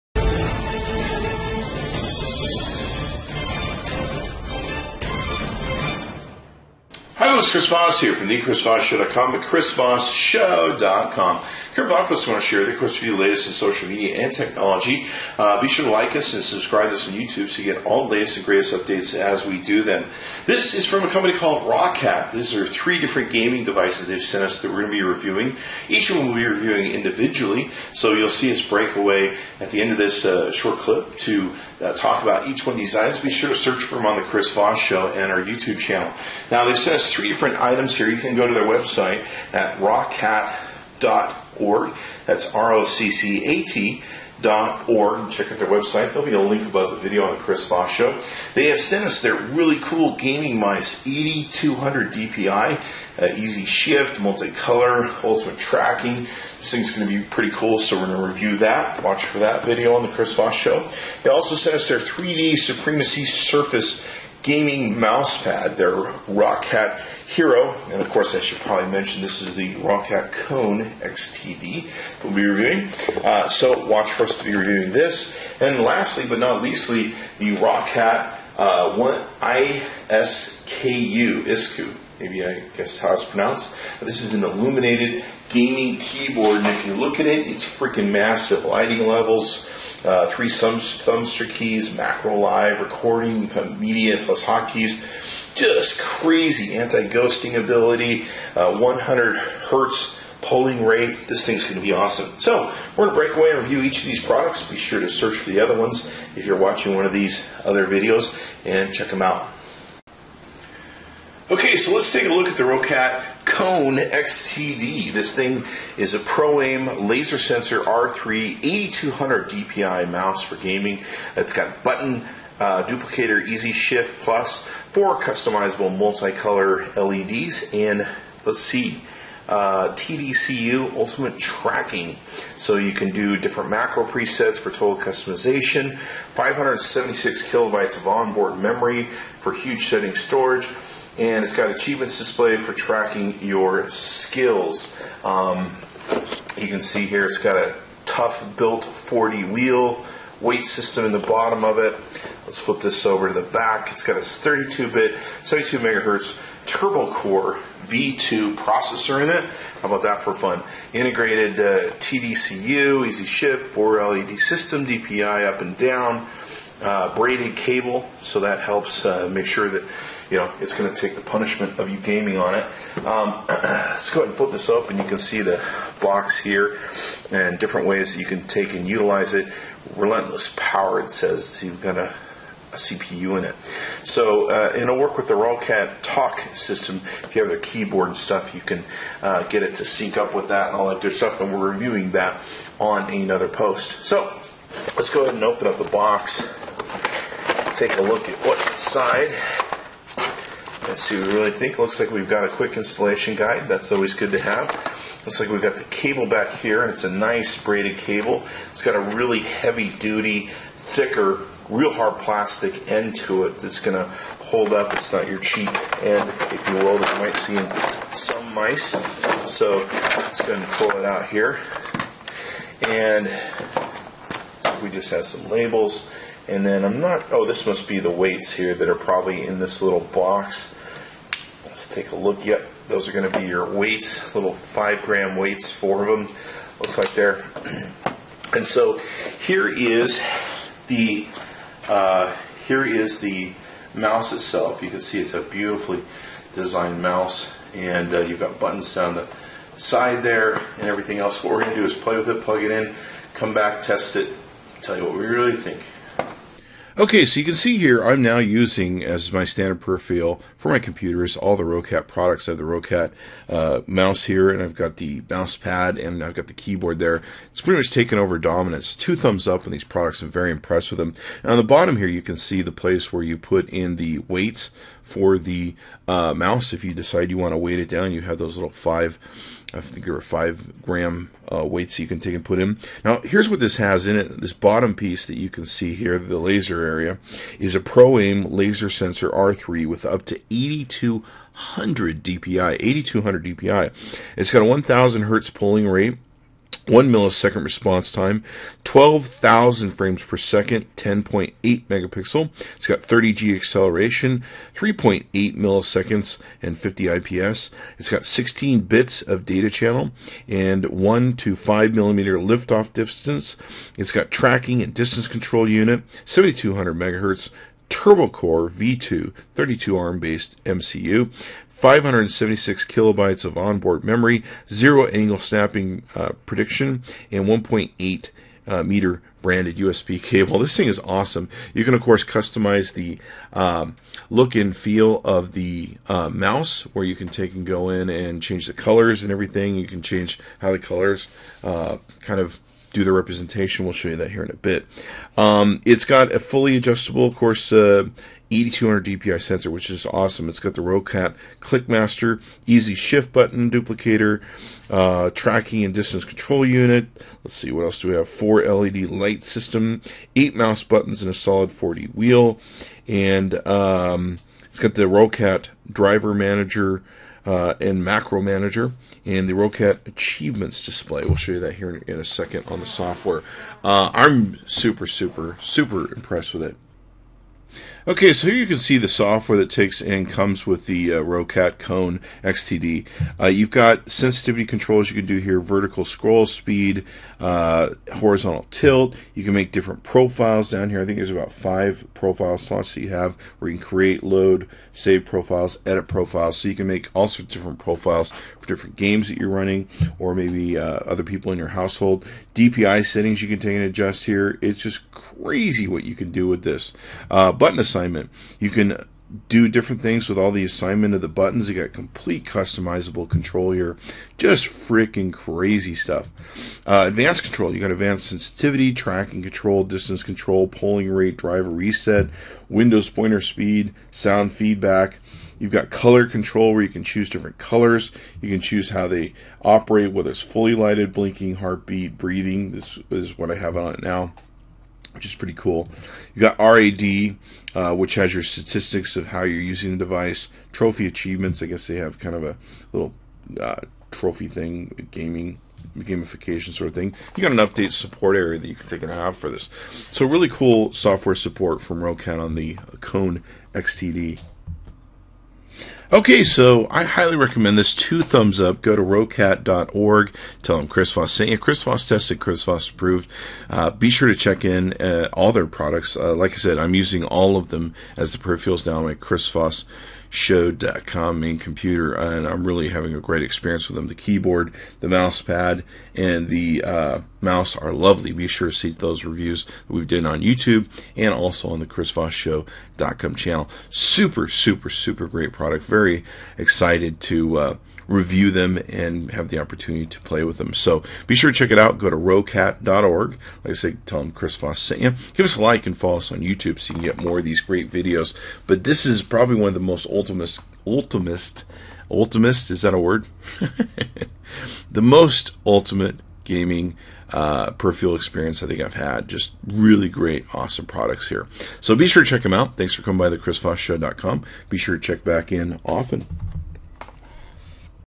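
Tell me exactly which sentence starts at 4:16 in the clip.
Okay, so you can see here I'm now using as my standard peripheral for my computers all the Roccat products.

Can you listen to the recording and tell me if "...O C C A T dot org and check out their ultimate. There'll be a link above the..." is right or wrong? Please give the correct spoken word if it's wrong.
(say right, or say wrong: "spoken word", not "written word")
wrong: "website", not "ultimate".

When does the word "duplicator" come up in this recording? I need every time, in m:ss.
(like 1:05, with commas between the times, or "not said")
2:02, 5:53.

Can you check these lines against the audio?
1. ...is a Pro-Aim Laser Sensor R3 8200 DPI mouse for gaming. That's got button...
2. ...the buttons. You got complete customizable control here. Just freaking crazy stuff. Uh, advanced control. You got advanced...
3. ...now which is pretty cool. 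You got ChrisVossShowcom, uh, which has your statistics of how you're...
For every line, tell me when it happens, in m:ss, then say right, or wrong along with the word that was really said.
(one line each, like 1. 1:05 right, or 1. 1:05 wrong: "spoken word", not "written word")
1. 1:56 right
2. 6:51 right
3. 7:14 wrong: "RAD", not "ChrisVossShowcom".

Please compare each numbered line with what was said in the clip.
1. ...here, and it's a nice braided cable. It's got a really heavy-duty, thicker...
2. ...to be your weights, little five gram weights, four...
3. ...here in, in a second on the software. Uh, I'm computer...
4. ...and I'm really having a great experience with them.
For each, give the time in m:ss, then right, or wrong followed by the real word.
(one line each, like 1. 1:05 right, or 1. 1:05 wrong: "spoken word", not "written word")
1. 3:26 right
2. 3:53 right
3. 6:11 wrong: "super", not "computer"
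4. 7:52 right.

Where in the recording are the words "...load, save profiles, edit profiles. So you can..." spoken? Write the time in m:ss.
6:34.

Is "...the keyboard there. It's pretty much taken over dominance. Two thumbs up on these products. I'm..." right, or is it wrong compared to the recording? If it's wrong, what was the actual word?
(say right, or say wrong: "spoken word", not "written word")
right.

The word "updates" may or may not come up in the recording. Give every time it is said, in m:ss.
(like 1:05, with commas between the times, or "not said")
0:18, 7:27.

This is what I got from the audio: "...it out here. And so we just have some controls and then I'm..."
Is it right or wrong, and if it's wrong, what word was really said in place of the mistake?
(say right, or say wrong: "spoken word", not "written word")
wrong: "labels", not "controls".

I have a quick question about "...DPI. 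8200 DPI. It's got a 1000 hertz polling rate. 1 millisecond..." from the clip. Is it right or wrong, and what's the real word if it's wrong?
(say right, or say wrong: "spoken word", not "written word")
right.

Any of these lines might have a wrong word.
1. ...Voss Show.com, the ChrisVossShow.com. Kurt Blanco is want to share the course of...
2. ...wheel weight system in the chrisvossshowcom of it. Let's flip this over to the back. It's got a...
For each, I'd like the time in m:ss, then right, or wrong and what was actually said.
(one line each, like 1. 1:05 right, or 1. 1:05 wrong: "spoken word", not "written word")
1. 0:08 right
2. 2:29 wrong: "bottom", not "chrisvossshowcom".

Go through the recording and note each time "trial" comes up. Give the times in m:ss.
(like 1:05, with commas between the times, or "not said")
not said.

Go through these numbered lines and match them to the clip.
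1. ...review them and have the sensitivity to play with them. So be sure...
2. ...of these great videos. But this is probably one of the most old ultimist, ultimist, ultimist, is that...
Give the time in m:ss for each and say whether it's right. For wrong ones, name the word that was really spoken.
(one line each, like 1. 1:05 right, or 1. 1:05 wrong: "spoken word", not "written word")
1. 8:08 wrong: "opportunity", not "sensitivity"
2. 8:17 right.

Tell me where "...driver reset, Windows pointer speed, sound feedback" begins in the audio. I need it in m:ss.
7:01.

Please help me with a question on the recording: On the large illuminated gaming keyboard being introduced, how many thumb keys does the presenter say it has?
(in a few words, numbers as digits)
3.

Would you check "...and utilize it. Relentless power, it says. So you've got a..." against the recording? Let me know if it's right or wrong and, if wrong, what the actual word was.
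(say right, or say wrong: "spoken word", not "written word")
right.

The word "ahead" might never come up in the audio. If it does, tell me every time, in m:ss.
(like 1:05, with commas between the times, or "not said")
2:54, 3:15.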